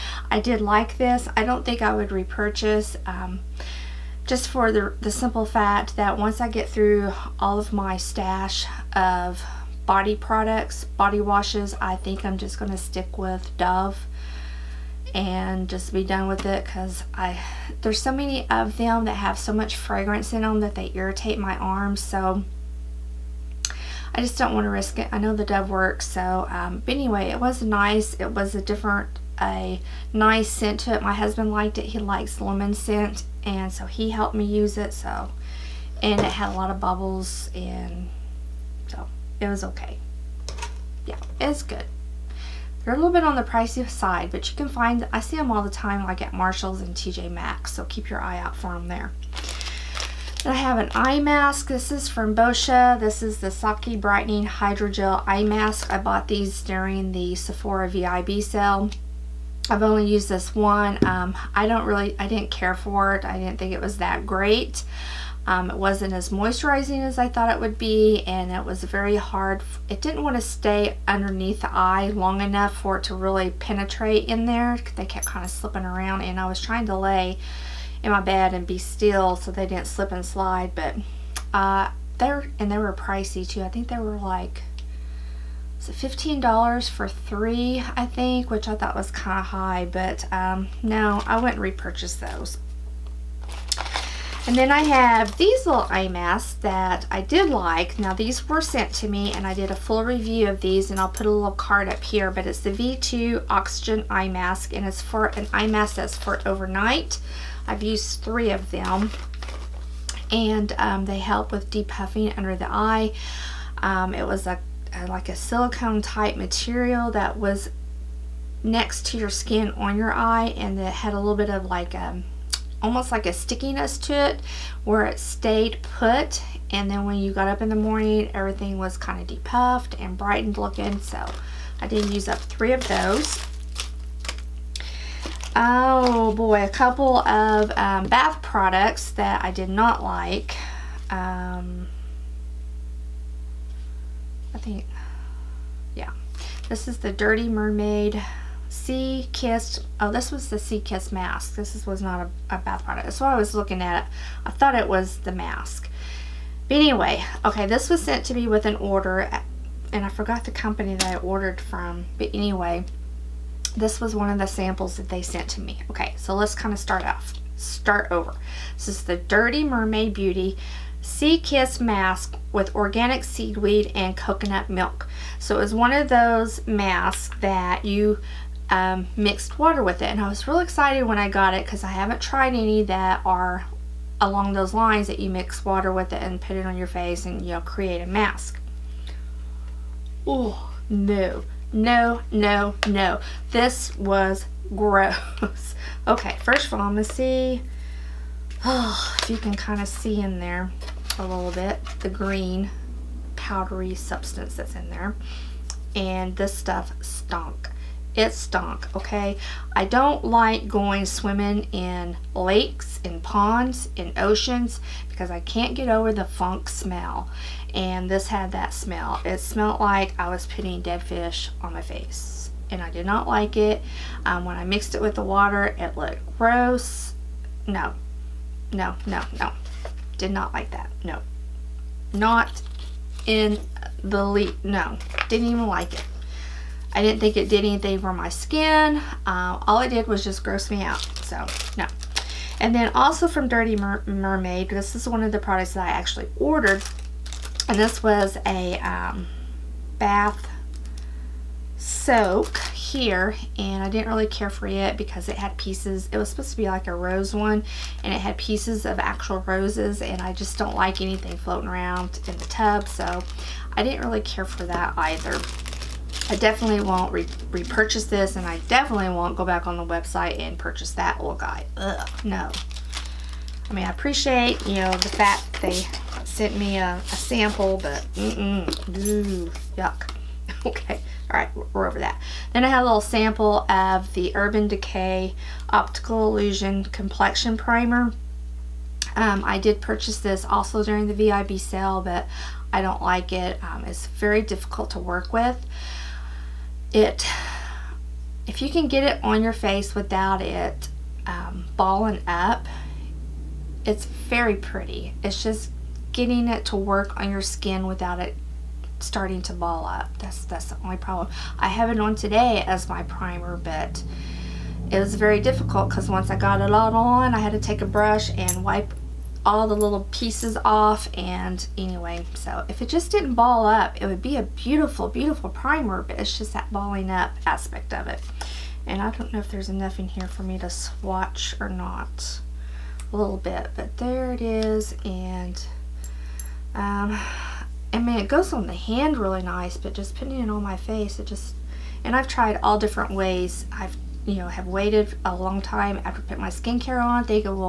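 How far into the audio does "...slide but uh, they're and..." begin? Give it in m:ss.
1:20.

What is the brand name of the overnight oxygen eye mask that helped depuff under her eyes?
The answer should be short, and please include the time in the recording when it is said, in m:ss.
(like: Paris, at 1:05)
V2, at 1:42.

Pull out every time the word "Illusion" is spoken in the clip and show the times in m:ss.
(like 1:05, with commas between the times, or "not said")
4:46.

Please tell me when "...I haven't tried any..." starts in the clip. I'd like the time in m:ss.
3:01.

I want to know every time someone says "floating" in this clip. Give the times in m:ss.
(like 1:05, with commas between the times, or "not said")
4:21.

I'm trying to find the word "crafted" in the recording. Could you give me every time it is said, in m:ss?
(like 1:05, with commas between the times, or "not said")
not said.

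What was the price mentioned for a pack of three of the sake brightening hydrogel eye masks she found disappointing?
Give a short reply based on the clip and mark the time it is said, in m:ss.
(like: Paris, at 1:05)
$15, at 1:25.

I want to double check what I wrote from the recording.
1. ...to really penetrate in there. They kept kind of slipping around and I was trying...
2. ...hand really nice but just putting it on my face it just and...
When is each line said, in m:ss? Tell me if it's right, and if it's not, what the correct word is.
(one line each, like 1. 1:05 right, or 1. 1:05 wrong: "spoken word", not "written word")
1. 1:13 right
2. 5:38 right.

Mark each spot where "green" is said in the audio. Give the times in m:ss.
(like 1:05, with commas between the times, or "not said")
3:22.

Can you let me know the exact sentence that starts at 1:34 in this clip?
And then I have these little eye masks that I did like.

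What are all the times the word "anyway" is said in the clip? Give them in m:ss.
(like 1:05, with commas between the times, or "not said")
0:26, 2:36, 2:42, 5:21.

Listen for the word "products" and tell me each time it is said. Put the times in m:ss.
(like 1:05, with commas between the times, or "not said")
0:10, 2:18, 2:32, 4:05.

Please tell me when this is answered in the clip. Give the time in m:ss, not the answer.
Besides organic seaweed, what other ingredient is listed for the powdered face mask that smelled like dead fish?
2:54.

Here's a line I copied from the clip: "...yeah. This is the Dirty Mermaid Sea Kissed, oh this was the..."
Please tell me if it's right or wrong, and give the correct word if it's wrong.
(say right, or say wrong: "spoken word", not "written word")
right.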